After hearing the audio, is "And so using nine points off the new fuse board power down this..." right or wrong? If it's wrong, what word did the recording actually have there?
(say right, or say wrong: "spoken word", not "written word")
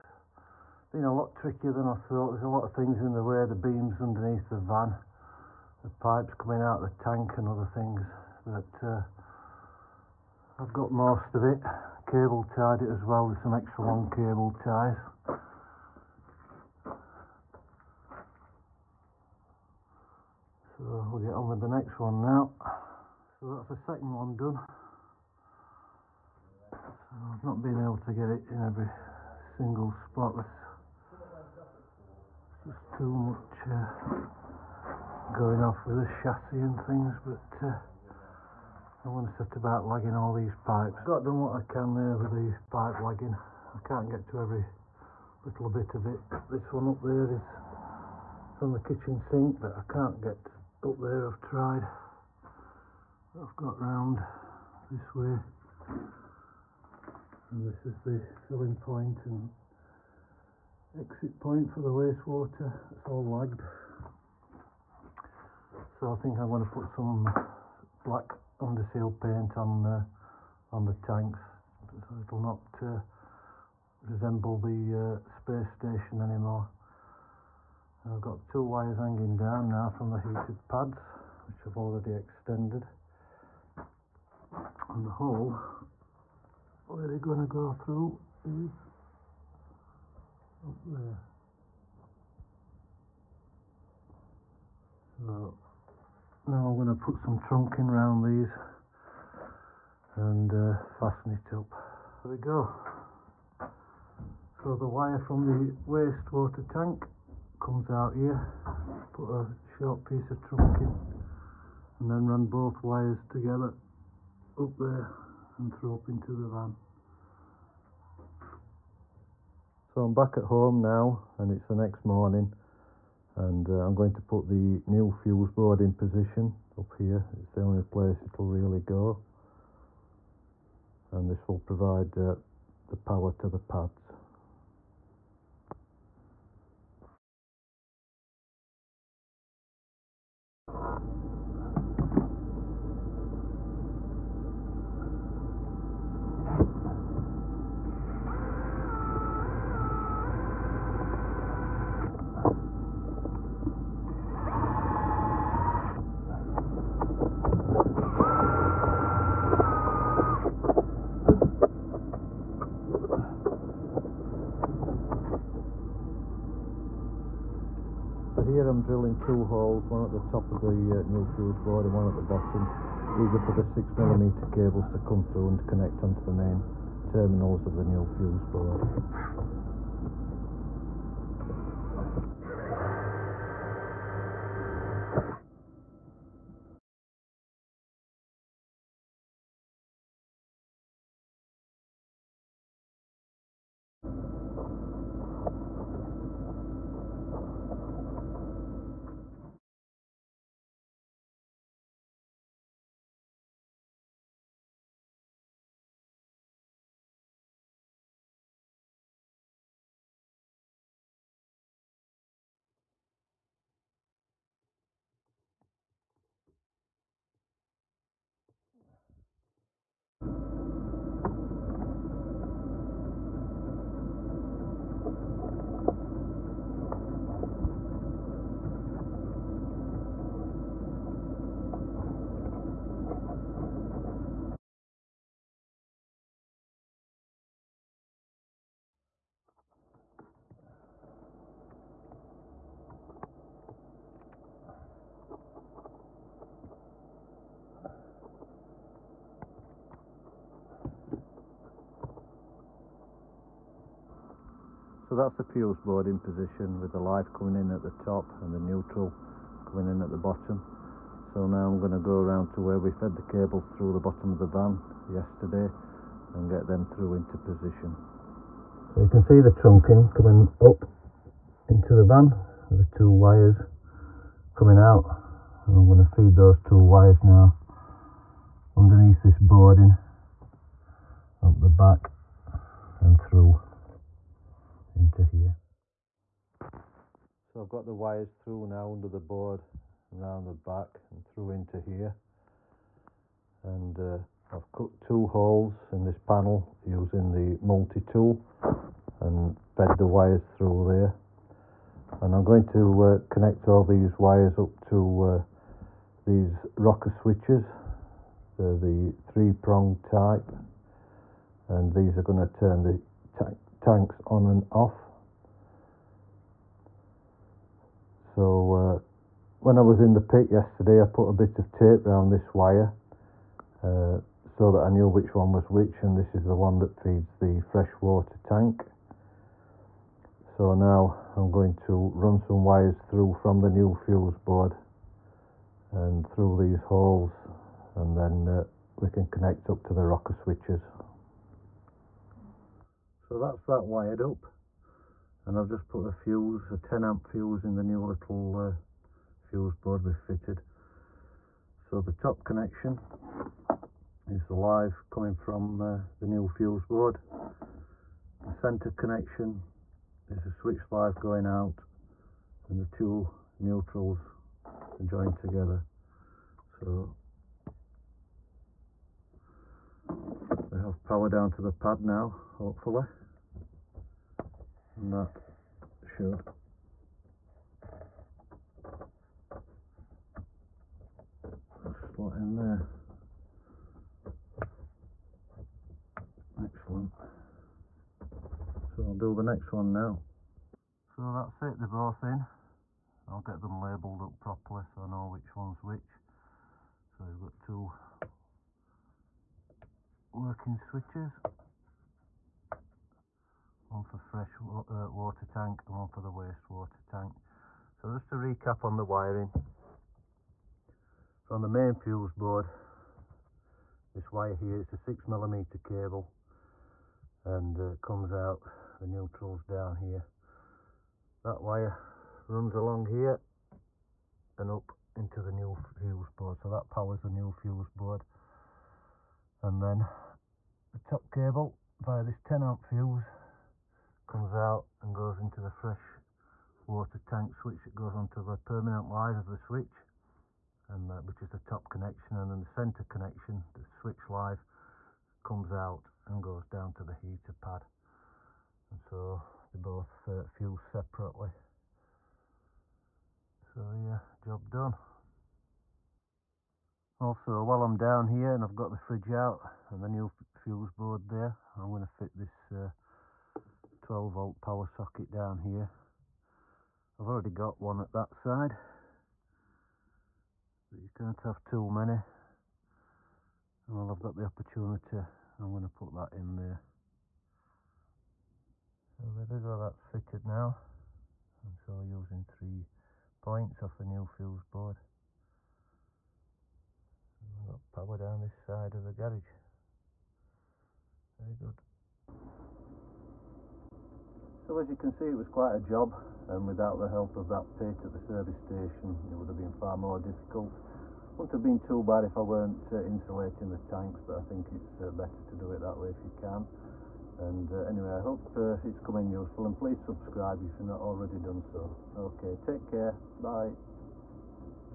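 wrong: "three", not "nine".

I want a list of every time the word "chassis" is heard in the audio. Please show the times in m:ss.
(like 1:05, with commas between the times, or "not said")
0:36.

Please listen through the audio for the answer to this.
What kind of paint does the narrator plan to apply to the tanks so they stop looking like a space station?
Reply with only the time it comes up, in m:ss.
1:08.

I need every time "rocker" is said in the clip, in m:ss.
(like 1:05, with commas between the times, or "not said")
5:06, 5:40.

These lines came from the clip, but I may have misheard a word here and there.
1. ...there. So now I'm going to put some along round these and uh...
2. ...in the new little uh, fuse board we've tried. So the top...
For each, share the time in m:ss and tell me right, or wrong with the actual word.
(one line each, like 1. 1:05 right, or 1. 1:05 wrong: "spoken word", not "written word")
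1. 1:30 wrong: "trunking", not "along"
2. 5:47 wrong: "fitted", not "tried".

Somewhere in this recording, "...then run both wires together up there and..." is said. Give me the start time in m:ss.
1:52.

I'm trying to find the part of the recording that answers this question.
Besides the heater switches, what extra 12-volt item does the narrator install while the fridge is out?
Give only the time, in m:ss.
7:44.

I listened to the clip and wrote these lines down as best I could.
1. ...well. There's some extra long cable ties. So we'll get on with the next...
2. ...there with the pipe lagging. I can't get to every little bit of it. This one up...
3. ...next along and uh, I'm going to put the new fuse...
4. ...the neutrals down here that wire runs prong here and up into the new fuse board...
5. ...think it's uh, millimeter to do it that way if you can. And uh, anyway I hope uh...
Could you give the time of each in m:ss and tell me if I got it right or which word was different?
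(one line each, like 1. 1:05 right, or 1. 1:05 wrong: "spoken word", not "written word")
1. 0:13 right
2. 0:41 right
3. 2:01 wrong: "morning", not "along"
4. 6:59 wrong: "along", not "prong"
5. 8:24 wrong: "better", not "millimeter".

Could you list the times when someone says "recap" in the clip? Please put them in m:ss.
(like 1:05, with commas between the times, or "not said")
6:48.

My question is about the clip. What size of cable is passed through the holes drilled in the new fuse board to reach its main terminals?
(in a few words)
6mm.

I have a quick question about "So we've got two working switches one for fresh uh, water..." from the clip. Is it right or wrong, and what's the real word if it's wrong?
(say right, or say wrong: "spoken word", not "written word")
right.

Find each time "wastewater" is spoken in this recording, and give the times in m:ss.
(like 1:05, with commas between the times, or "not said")
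1:01, 1:45, 6:46.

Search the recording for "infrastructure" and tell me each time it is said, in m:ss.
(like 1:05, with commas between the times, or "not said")
not said.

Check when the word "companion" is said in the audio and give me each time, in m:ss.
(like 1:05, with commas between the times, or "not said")
not said.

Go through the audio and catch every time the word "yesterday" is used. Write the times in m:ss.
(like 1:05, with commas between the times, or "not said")
4:25, 5:20.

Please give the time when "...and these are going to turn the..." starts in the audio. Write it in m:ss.
5:11.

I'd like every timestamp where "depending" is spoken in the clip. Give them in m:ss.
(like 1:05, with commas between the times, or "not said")
not said.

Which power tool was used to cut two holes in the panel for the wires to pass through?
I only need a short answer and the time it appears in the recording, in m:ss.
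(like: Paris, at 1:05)
Multi-tool, at 4:57.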